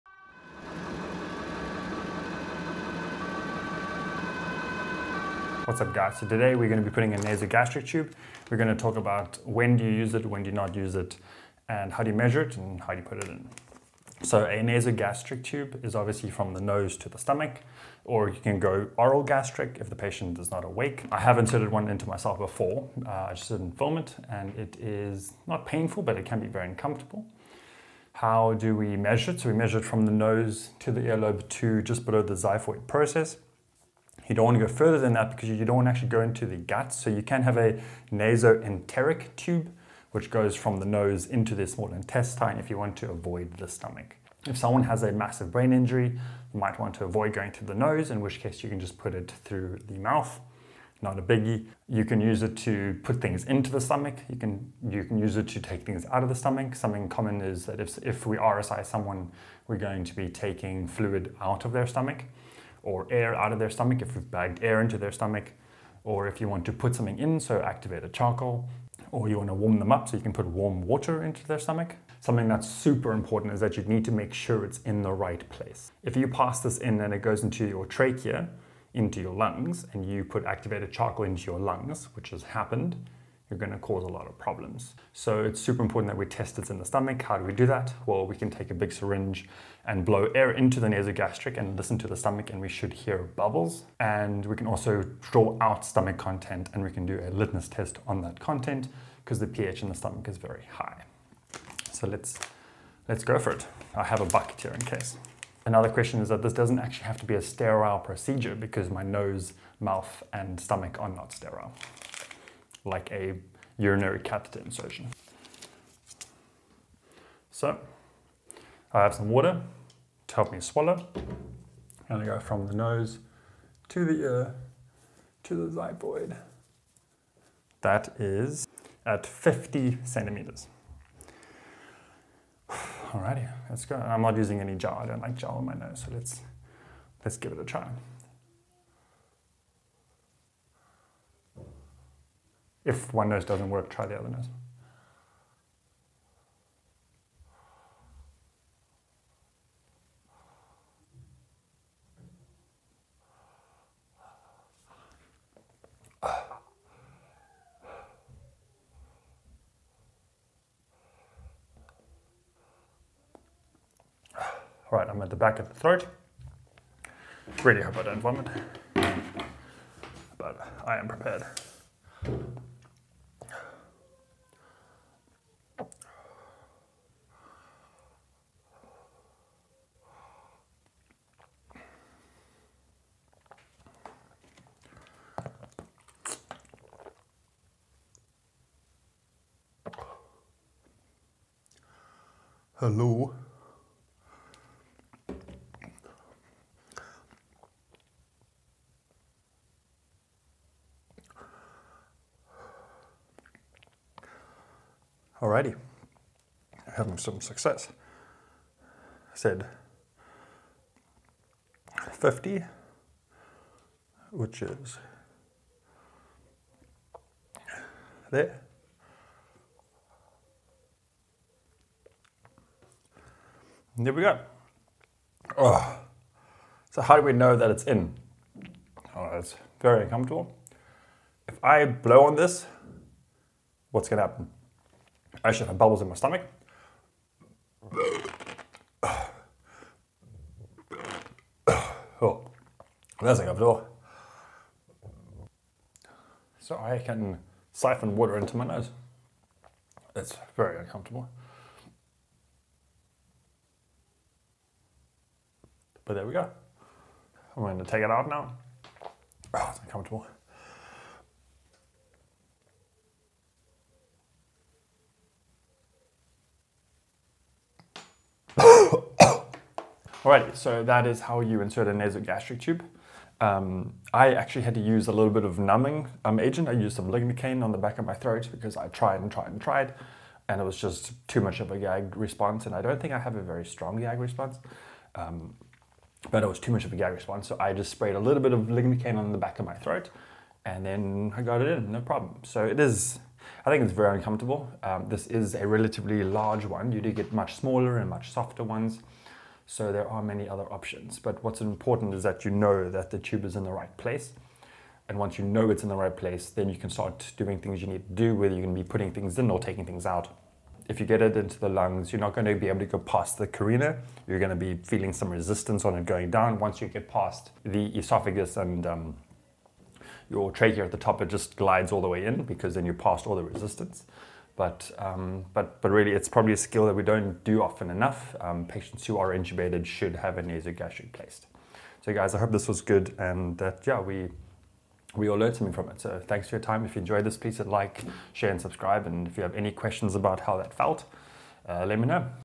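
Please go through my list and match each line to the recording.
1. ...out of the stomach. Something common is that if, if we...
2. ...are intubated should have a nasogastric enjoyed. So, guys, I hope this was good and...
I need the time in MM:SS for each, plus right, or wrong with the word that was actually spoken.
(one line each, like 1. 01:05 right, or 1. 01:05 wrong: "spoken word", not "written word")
1. 00:56 right
2. 05:29 wrong: "placed", not "enjoyed".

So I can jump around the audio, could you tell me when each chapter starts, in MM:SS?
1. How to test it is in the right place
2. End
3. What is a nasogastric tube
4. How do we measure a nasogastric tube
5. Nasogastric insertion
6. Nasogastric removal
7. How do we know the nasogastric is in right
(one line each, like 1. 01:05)
1. 01:28
2. 04:30
3. 00:15
4. 00:27
5. 02:00
6. 04:17
7. 03:46.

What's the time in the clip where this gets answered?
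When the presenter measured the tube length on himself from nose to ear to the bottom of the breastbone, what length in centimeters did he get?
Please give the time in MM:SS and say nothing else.
02:09.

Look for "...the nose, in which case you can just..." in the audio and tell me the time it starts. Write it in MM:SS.
00:47.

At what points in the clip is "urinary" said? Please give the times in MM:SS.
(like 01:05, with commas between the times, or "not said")
01:53.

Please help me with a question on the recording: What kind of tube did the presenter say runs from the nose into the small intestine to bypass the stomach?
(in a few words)
nasoenteric tube.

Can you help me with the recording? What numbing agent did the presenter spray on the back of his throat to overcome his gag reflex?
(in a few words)
lignocaine.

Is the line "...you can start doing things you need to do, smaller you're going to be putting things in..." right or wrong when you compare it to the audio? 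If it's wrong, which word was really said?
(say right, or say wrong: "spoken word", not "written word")
wrong: "whether", not "smaller".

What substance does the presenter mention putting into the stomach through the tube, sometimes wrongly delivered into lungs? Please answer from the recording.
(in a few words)
activated charcoal.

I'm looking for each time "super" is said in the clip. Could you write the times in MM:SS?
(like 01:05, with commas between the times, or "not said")
01:12, 01:25.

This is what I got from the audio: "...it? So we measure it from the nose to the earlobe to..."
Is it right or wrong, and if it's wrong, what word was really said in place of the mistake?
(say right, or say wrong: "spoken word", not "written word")
right.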